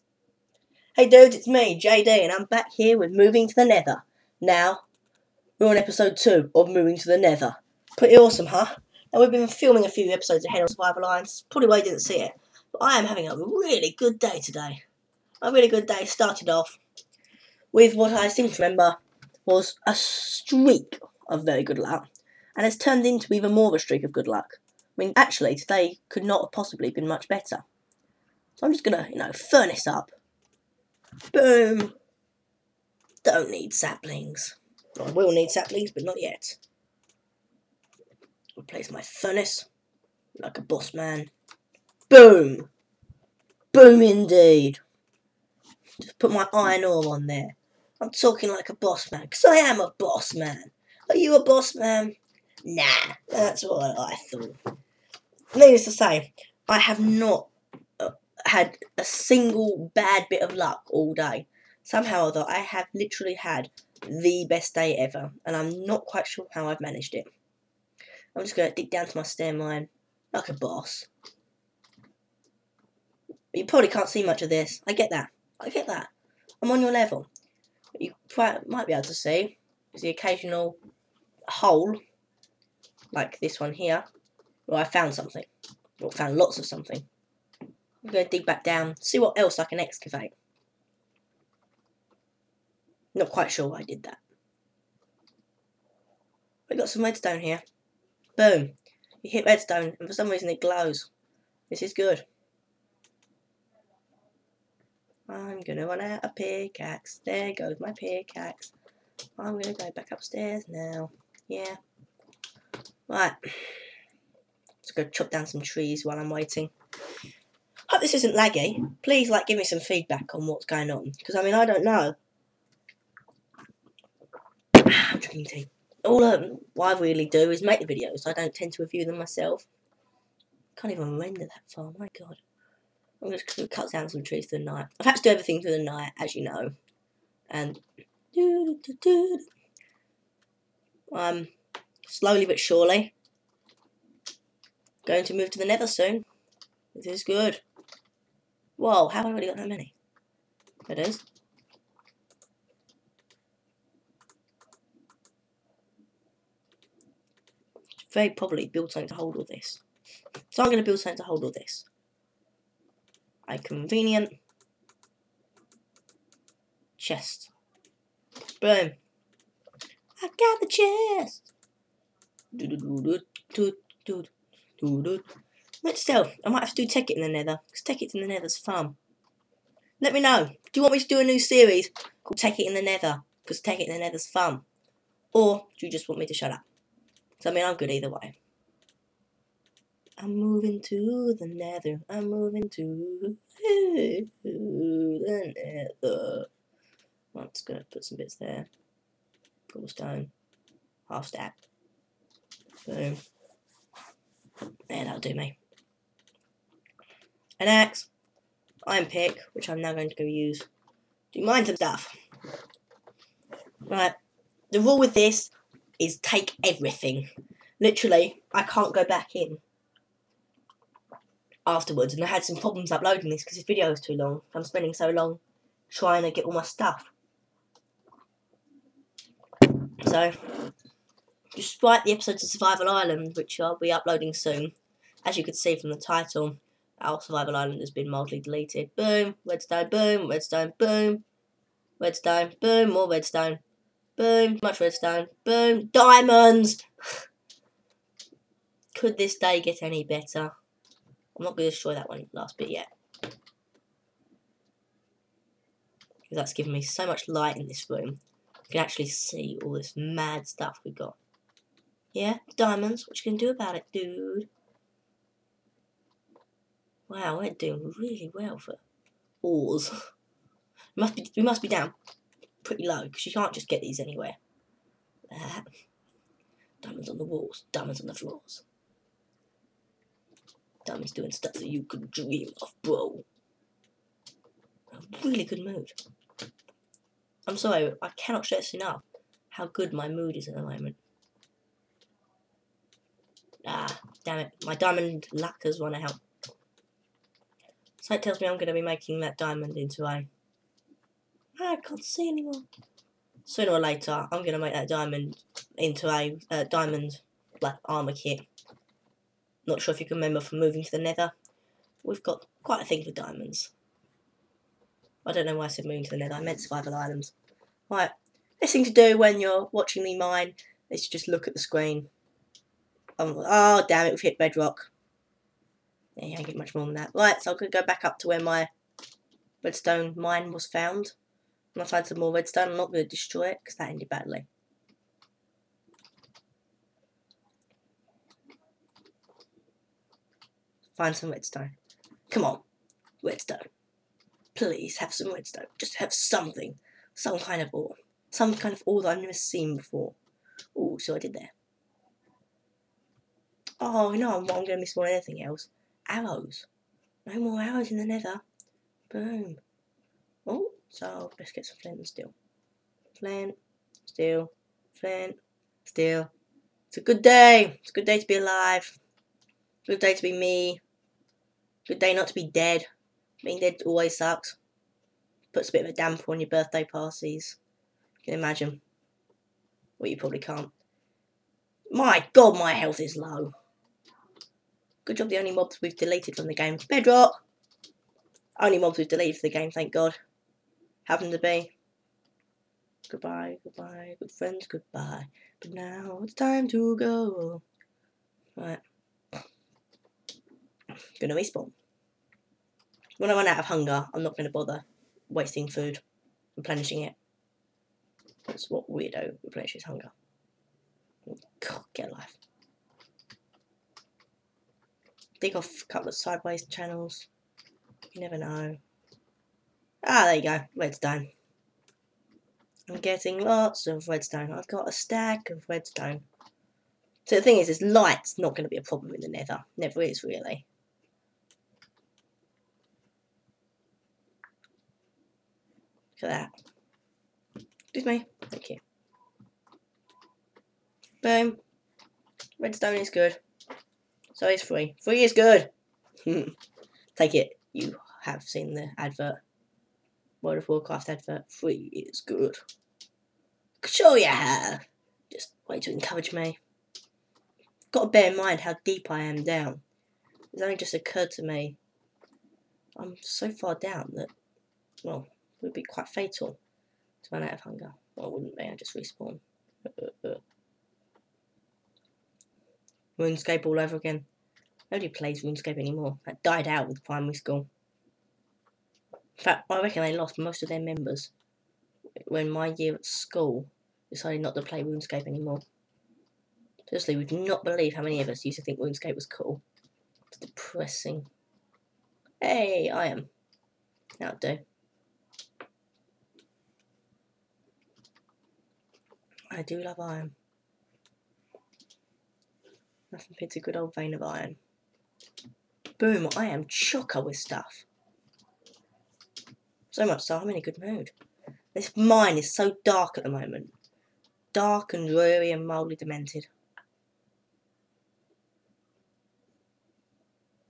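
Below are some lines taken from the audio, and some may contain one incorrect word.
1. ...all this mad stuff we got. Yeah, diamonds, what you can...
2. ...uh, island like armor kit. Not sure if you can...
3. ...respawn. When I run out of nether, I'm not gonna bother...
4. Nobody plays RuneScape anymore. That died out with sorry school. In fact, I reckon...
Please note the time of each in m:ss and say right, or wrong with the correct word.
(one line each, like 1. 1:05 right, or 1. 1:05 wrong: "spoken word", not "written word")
1. 4:19 right
2. 5:06 wrong: "diamond", not "island"
3. 6:41 wrong: "hunger", not "nether"
4. 7:54 wrong: "primary", not "sorry".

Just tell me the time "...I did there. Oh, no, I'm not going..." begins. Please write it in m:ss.
5:51.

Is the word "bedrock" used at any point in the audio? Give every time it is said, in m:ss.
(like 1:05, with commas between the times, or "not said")
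5:24, 6:26.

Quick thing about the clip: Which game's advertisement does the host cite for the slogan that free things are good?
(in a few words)
World of Warcraft.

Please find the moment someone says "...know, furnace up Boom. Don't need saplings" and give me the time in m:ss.
0:29.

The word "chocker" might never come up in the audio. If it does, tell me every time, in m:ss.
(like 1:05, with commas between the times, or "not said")
8:26.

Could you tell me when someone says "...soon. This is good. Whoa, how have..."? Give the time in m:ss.
2:25.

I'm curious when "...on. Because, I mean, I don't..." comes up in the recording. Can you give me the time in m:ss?
2:00.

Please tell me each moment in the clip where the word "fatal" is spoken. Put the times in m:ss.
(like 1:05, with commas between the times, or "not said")
7:46.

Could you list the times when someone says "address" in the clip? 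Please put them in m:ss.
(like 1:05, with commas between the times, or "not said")
not said.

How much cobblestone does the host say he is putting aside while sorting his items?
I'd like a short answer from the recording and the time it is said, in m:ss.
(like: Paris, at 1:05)
Half stack, at 3:21.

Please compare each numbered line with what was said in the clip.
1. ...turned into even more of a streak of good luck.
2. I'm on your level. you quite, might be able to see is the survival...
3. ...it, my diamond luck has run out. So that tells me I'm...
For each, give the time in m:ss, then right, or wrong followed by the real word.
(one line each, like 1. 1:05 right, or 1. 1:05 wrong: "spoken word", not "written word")
1. 0:22 right
2. 1:16 wrong: "occasional", not "survival"
3. 4:54 right.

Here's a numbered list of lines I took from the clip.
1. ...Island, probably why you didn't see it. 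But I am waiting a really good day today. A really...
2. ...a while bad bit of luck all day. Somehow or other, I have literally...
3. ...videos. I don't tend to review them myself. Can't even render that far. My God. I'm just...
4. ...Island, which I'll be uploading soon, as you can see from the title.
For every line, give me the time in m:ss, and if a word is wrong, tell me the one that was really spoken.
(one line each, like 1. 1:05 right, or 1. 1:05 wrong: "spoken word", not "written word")
1. 0:11 wrong: "having", not "waiting"
2. 0:58 wrong: "single", not "while"
3. 2:07 right
4. 3:52 right.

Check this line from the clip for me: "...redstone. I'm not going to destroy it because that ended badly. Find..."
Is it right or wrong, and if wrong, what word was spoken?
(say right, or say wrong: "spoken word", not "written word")
right.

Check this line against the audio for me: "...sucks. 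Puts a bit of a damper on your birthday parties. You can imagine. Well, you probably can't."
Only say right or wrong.
right.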